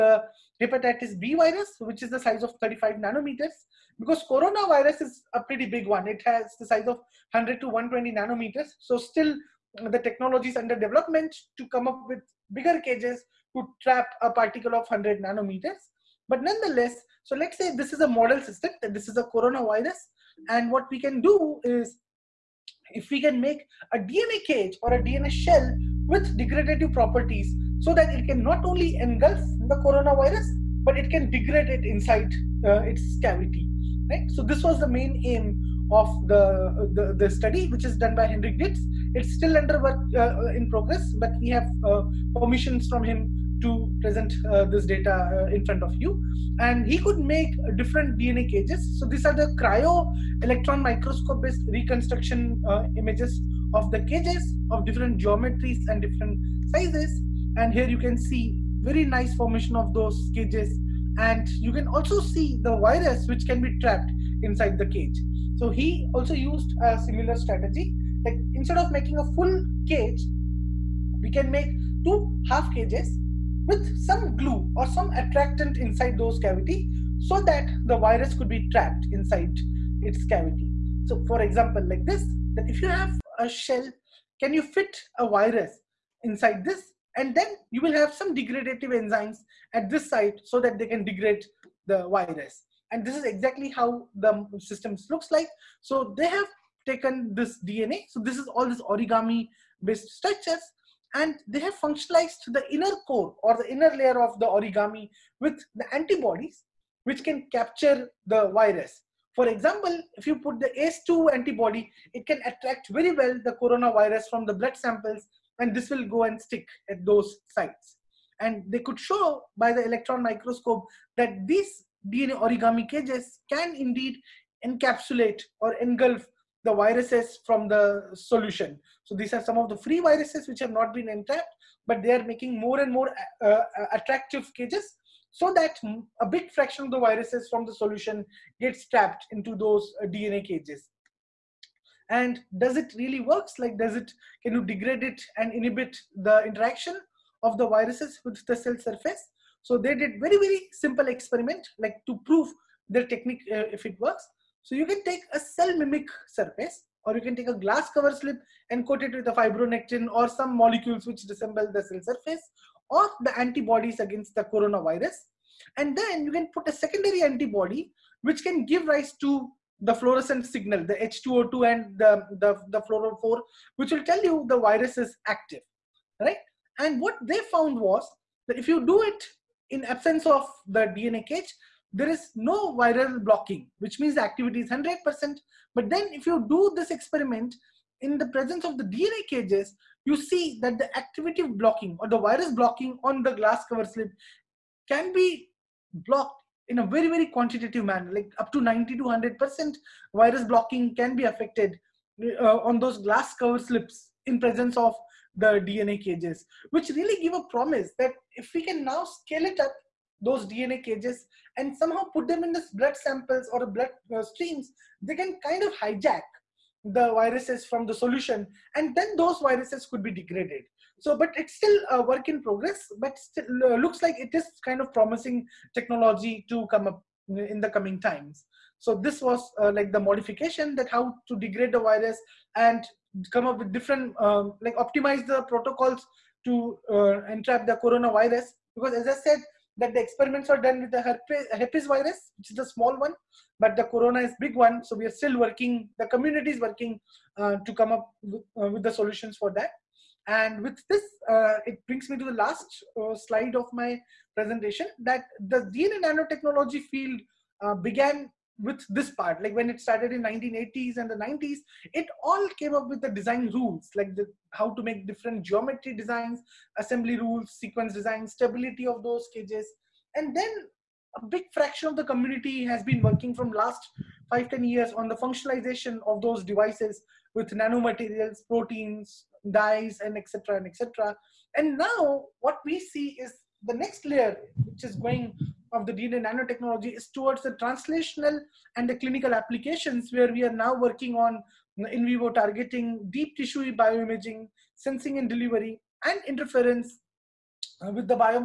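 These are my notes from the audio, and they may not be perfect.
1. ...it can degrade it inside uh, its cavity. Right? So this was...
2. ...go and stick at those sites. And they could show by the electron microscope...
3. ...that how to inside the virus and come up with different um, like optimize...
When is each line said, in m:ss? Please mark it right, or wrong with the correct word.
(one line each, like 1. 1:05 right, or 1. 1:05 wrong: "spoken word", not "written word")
1. 0:30 right
2. 1:56 right
3. 3:50 wrong: "degrade", not "inside".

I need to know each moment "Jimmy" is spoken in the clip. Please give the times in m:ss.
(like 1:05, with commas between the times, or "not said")
not said.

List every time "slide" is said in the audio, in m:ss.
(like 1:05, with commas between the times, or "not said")
4:13.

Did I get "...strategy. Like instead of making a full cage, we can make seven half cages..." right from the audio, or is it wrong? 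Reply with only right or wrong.
wrong.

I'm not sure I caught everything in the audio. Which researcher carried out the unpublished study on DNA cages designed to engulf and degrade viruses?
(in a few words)
Hendrik Dietz.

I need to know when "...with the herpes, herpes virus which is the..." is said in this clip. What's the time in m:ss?
4:00.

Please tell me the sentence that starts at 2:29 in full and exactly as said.
So they did very, very simple experiment like to prove their technique uh, if it works.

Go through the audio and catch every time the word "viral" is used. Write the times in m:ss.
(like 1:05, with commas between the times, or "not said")
3:02.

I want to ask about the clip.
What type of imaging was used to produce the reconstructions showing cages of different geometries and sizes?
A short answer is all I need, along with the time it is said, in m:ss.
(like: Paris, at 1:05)
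cryo electron microscope, at 0:49.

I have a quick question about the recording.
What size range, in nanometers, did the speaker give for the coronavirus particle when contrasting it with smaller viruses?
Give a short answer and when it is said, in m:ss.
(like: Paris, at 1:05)
100 to 120 nanometers, at 0:07.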